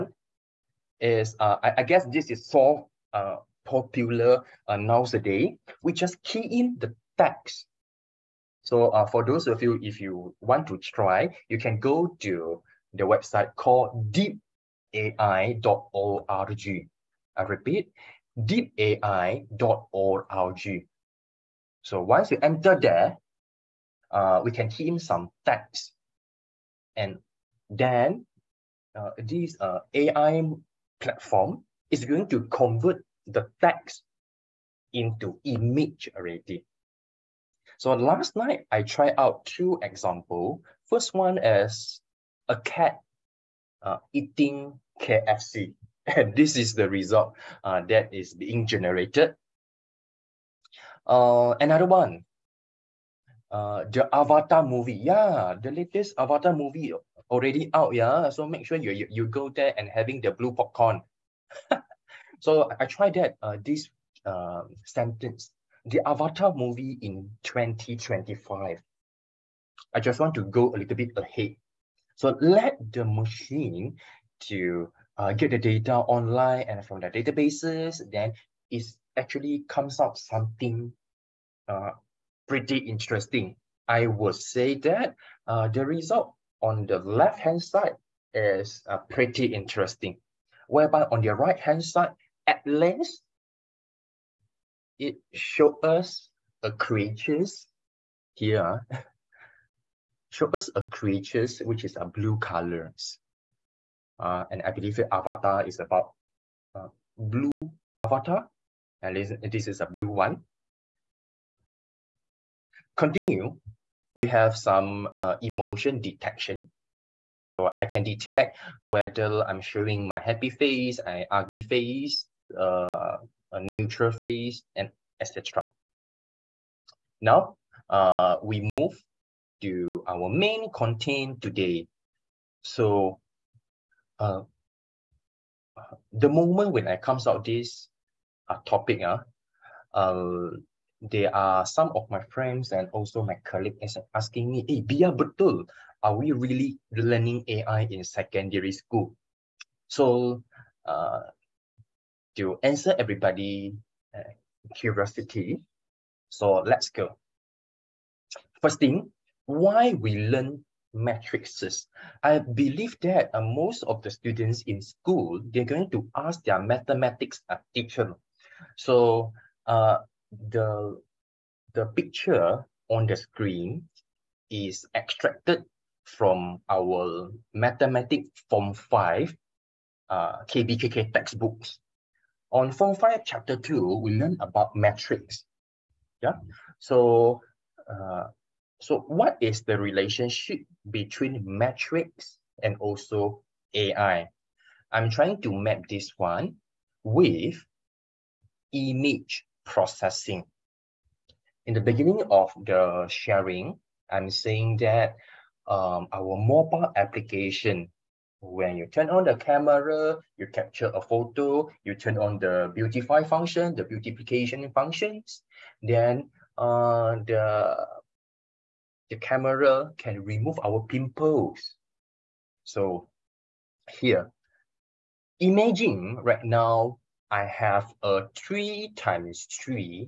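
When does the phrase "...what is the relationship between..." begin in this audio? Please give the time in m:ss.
3:09.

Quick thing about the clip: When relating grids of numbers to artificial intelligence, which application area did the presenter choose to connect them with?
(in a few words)
image processing.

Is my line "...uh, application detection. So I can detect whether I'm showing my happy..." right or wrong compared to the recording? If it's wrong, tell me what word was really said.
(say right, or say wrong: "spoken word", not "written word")
wrong: "emotion", not "application".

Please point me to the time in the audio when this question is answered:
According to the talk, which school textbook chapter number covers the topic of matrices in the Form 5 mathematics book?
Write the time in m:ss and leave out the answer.
3:03.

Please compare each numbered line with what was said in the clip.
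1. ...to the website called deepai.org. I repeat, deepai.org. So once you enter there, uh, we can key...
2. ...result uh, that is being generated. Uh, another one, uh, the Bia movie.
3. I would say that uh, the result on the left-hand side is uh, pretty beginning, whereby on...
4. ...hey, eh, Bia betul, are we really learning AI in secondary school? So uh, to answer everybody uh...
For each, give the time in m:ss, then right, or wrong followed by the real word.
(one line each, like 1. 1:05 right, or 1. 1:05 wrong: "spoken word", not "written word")
1. 0:12 right
2. 0:46 wrong: "Avatar", not "Bia"
3. 1:23 wrong: "interesting", not "beginning"
4. 2:24 right.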